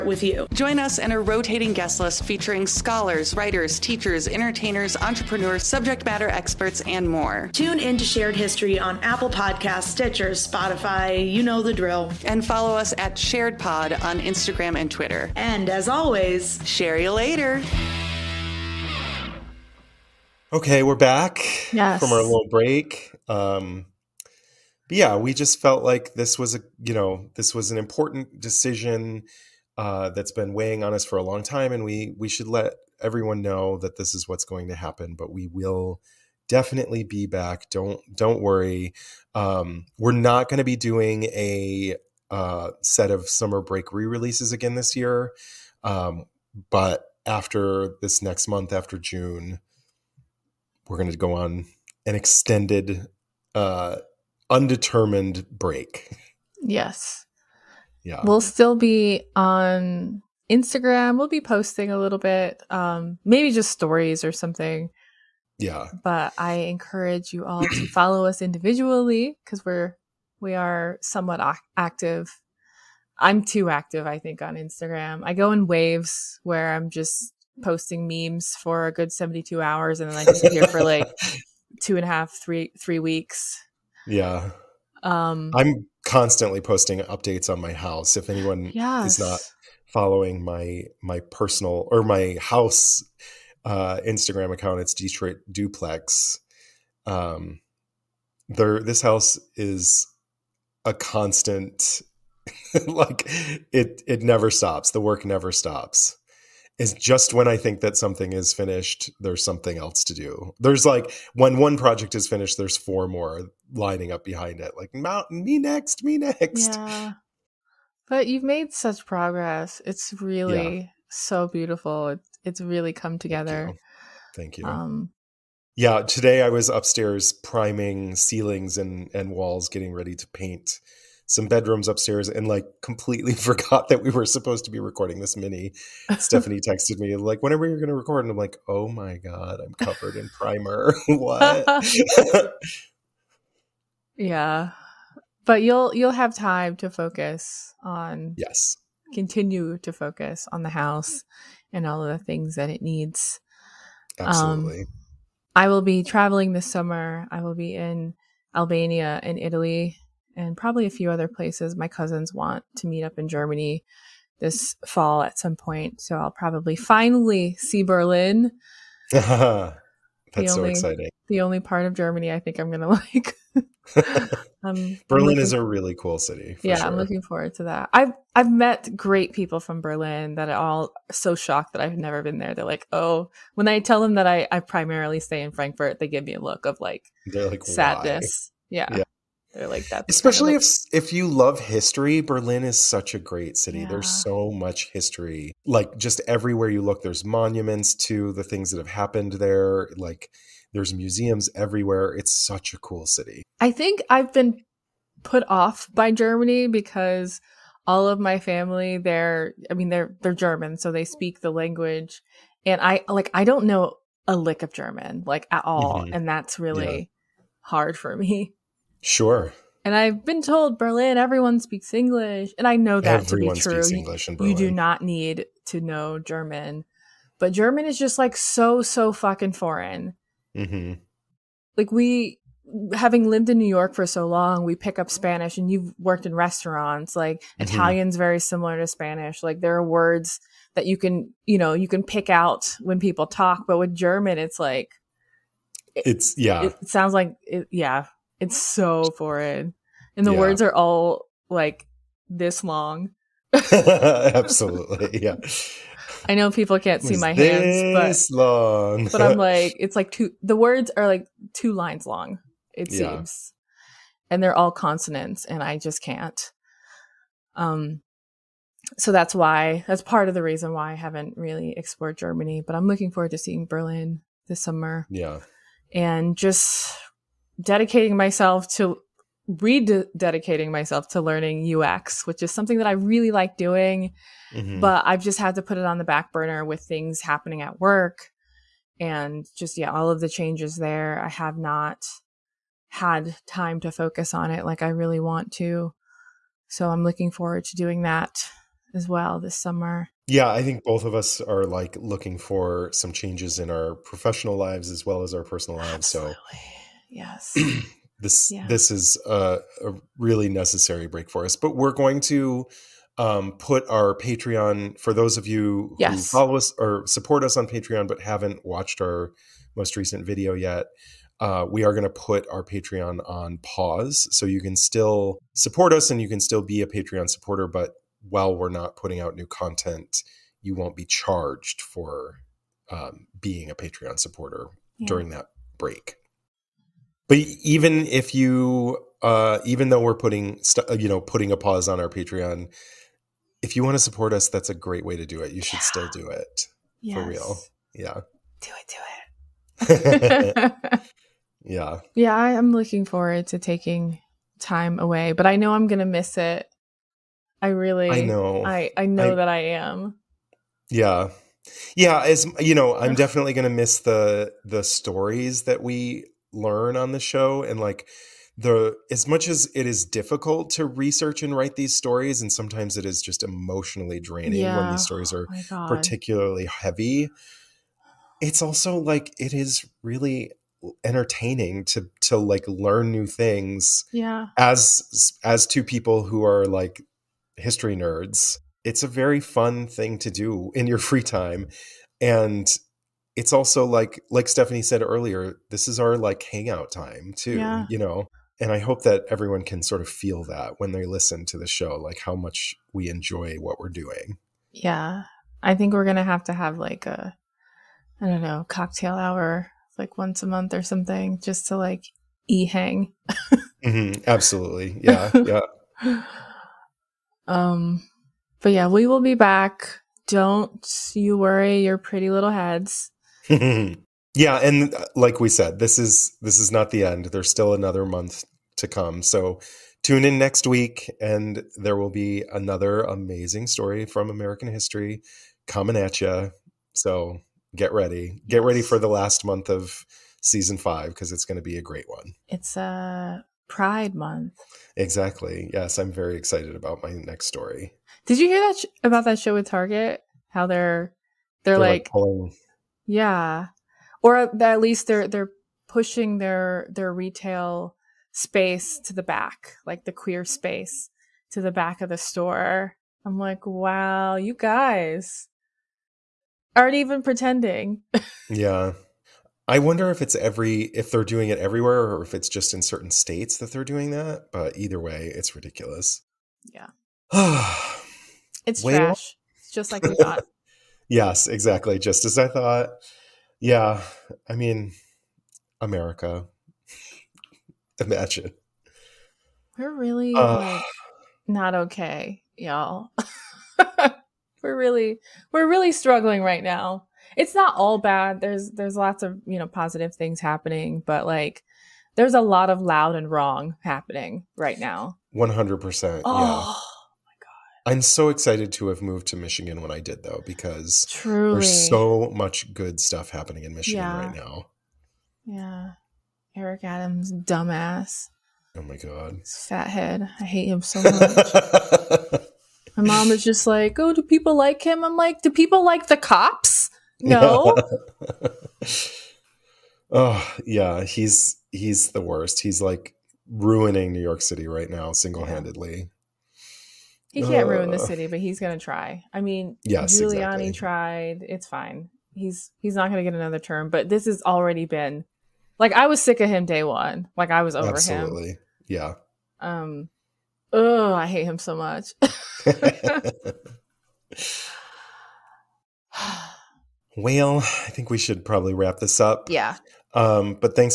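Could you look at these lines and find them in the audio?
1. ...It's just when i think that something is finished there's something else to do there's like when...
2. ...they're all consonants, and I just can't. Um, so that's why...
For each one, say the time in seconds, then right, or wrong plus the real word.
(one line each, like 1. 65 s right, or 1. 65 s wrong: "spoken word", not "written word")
1. 106 s right
2. 264 s right.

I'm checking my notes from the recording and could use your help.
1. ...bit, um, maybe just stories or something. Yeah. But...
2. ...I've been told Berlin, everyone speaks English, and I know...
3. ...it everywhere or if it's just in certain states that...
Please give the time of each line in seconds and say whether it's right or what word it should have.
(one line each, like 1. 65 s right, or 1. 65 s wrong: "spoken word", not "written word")
1. 62 s right
2. 219 s right
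3. 471 s right.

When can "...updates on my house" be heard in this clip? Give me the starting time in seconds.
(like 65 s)
86 s.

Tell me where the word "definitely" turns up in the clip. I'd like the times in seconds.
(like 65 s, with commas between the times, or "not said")
36 s, 363 s.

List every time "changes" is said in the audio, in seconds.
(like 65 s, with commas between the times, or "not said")
290 s, 303 s.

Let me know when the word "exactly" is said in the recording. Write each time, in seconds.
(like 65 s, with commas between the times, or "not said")
444 s, 481 s, 540 s.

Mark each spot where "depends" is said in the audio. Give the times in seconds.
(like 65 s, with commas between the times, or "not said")
not said.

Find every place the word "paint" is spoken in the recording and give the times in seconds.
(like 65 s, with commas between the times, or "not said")
130 s.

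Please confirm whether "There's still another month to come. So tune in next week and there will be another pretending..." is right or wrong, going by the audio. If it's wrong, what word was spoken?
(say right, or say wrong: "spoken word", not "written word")
wrong: "amazing", not "pretending".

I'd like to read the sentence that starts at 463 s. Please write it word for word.
I'm like, wow, you guys aren't even pretending.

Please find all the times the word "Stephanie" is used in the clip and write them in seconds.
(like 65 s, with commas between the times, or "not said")
136 s, 394 s.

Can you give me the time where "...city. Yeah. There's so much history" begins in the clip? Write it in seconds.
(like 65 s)
193 s.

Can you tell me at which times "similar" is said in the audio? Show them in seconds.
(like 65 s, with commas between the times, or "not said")
238 s.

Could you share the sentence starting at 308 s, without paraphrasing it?
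this is a, a, really necessary break for us, but we're going to um, put our Patreon for those of you yes.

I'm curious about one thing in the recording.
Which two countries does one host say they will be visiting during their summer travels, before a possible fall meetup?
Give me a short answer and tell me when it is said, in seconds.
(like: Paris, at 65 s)
Albania and Italy, at 158 s.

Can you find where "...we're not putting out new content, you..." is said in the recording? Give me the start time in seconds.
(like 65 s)
328 s.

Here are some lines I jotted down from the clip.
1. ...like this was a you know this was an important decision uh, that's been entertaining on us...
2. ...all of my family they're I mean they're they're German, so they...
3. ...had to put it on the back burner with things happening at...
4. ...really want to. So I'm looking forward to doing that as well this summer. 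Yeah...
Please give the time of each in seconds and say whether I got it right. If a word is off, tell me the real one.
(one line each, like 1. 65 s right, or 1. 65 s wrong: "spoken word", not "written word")
1. 25 s wrong: "weighing", not "entertaining"
2. 207 s right
3. 285 s right
4. 294 s right.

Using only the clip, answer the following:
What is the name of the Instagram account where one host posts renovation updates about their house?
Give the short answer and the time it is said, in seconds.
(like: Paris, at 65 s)
Detroit Duplex, at 94 s.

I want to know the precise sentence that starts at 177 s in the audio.
I've I've met great people from Berlin that are all so shocked that I've never been there.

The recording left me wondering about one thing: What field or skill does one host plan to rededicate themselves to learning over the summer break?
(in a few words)
UX.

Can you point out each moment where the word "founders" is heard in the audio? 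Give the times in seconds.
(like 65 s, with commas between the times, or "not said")
not said.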